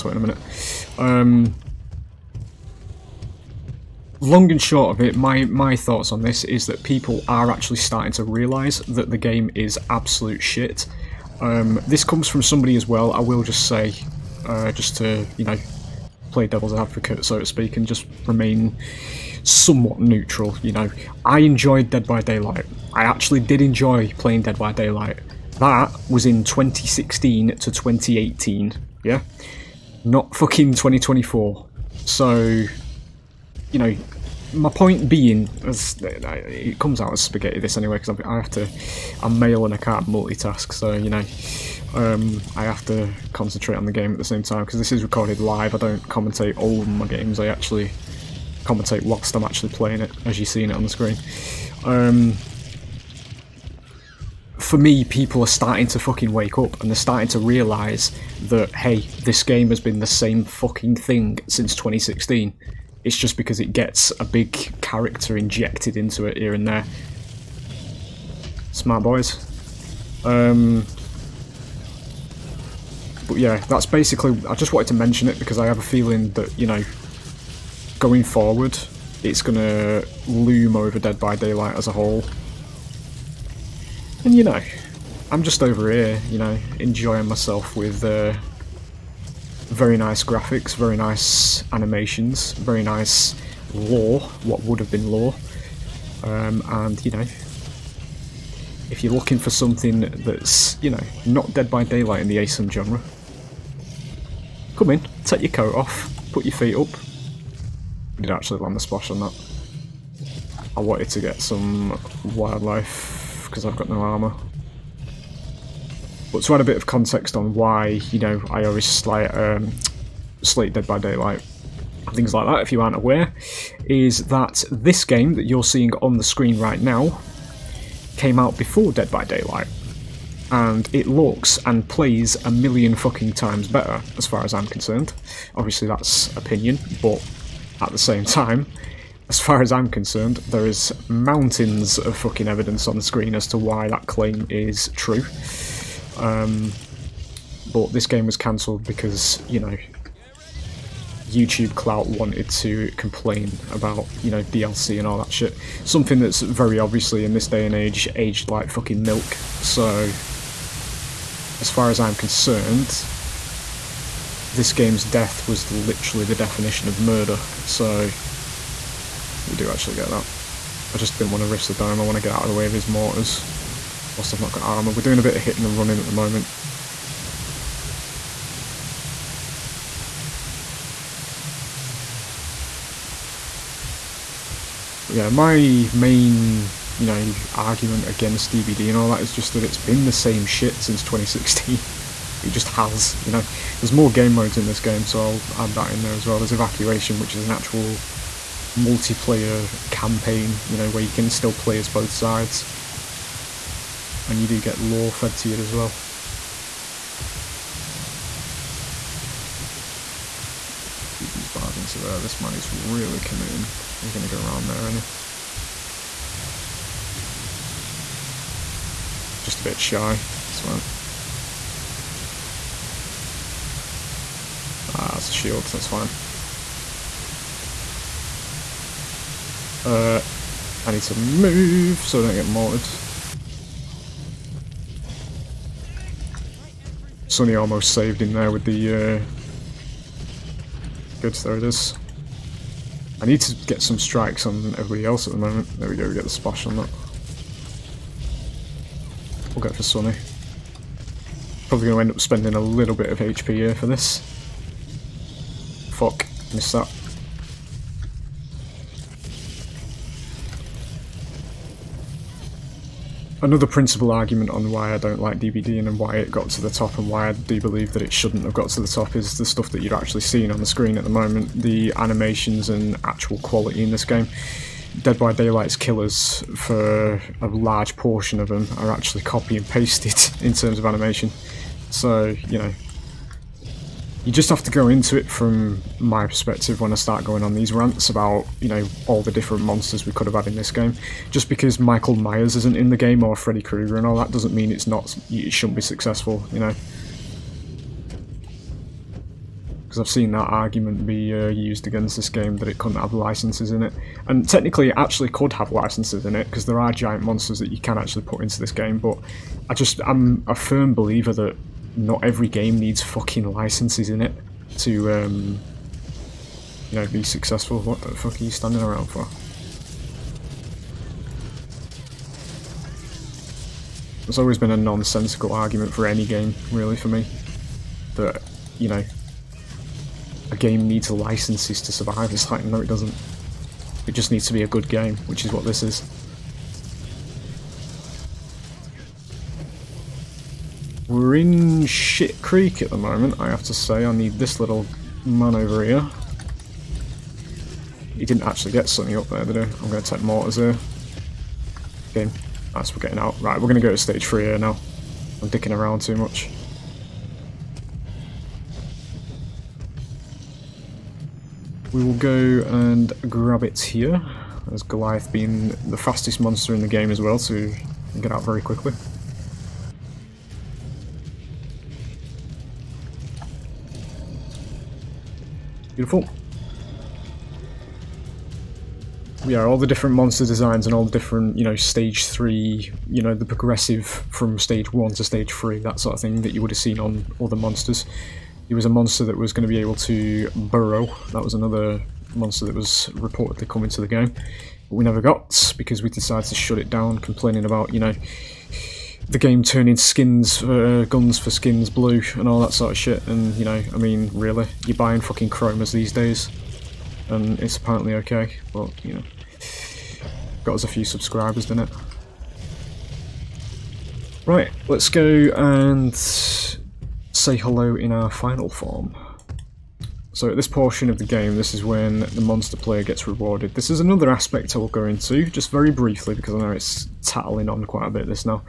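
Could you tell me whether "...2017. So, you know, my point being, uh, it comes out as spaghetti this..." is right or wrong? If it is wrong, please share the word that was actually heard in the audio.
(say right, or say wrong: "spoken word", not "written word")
wrong: "2024", not "2017".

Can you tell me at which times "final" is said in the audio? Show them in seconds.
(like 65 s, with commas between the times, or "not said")
418 s.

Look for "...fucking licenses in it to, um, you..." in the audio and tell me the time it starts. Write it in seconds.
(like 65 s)
313 s.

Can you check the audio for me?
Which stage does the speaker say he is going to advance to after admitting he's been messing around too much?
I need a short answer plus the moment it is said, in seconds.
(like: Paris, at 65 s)
Stage 3, at 353 s.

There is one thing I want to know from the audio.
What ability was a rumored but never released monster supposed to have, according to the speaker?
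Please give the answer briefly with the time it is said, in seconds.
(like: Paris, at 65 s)
Burrow, at 390 s.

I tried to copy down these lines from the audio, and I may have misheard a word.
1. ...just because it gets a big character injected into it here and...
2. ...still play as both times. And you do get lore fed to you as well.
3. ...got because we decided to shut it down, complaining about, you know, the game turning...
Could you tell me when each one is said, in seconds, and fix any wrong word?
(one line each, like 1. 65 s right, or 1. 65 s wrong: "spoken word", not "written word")
1. 63 s right
2. 201 s wrong: "sides", not "times"
3. 395 s right.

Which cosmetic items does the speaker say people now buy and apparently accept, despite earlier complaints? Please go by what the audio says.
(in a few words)
Chromas.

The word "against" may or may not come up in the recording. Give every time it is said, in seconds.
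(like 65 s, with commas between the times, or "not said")
188 s, 301 s.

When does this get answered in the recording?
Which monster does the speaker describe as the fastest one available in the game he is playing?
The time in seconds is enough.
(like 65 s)
364 s.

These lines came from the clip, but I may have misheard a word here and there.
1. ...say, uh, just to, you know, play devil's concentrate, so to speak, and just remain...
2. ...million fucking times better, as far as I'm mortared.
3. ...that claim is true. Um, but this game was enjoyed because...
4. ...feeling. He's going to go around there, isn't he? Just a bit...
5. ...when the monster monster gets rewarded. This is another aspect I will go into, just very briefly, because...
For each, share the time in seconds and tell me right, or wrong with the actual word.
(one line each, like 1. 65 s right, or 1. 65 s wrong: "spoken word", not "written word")
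1. 13 s wrong: "advocate", not "concentrate"
2. 132 s wrong: "concerned", not "mortared"
3. 143 s wrong: "cancelled", not "enjoyed"
4. 213 s wrong: "committing", not "feeling"
5. 421 s wrong: "player", not "monster".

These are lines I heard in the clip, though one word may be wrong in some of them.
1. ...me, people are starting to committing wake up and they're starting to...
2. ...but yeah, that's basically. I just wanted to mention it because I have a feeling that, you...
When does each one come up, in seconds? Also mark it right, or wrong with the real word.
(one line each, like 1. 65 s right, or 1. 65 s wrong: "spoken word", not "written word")
1. 54 s wrong: "fucking", not "committing"
2. 73 s right.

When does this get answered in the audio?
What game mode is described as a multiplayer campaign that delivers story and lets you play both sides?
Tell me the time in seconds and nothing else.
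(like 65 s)
196 s.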